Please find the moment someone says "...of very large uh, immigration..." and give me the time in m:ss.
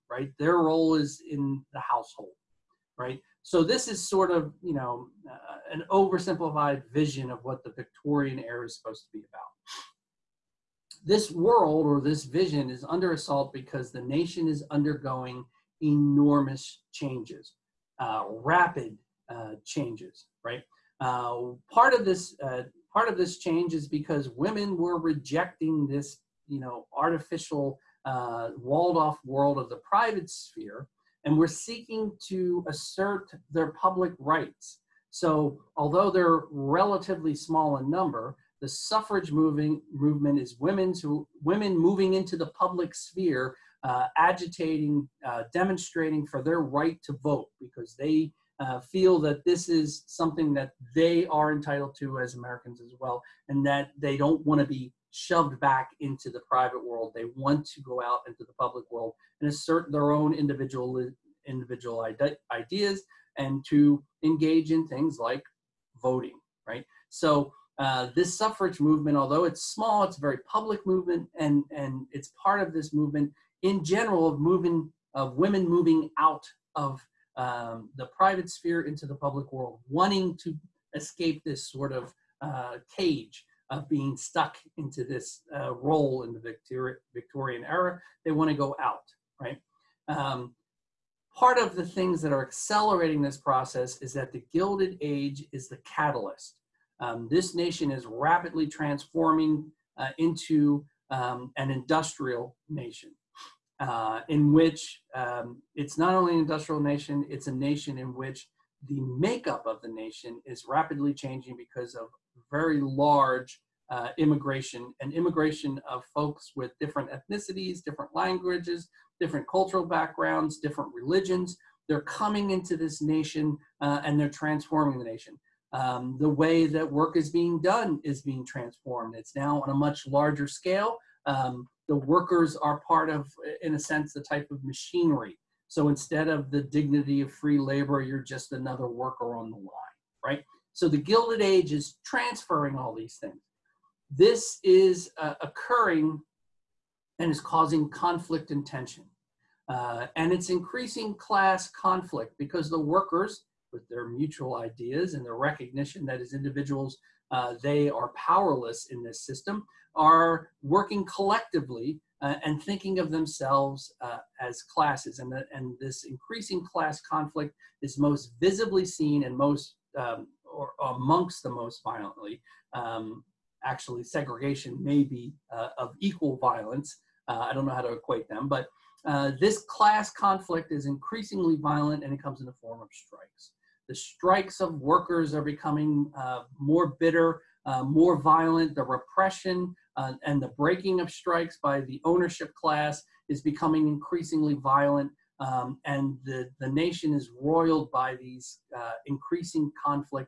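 1:51.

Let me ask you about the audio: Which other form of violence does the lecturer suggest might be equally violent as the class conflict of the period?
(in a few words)
segregation.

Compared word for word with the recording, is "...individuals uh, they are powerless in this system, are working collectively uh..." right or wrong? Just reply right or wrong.
right.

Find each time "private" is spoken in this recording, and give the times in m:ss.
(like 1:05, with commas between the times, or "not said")
0:29, 0:56, 1:18.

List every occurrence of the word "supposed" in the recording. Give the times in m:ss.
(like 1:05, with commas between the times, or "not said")
0:08.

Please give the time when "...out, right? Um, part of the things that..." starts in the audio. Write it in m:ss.
1:28.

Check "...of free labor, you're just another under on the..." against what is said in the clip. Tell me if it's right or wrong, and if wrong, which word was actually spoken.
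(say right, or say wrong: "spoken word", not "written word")
wrong: "worker", not "under".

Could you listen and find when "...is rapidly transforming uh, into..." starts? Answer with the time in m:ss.
1:37.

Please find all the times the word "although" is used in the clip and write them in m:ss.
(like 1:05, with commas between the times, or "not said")
0:35, 1:09.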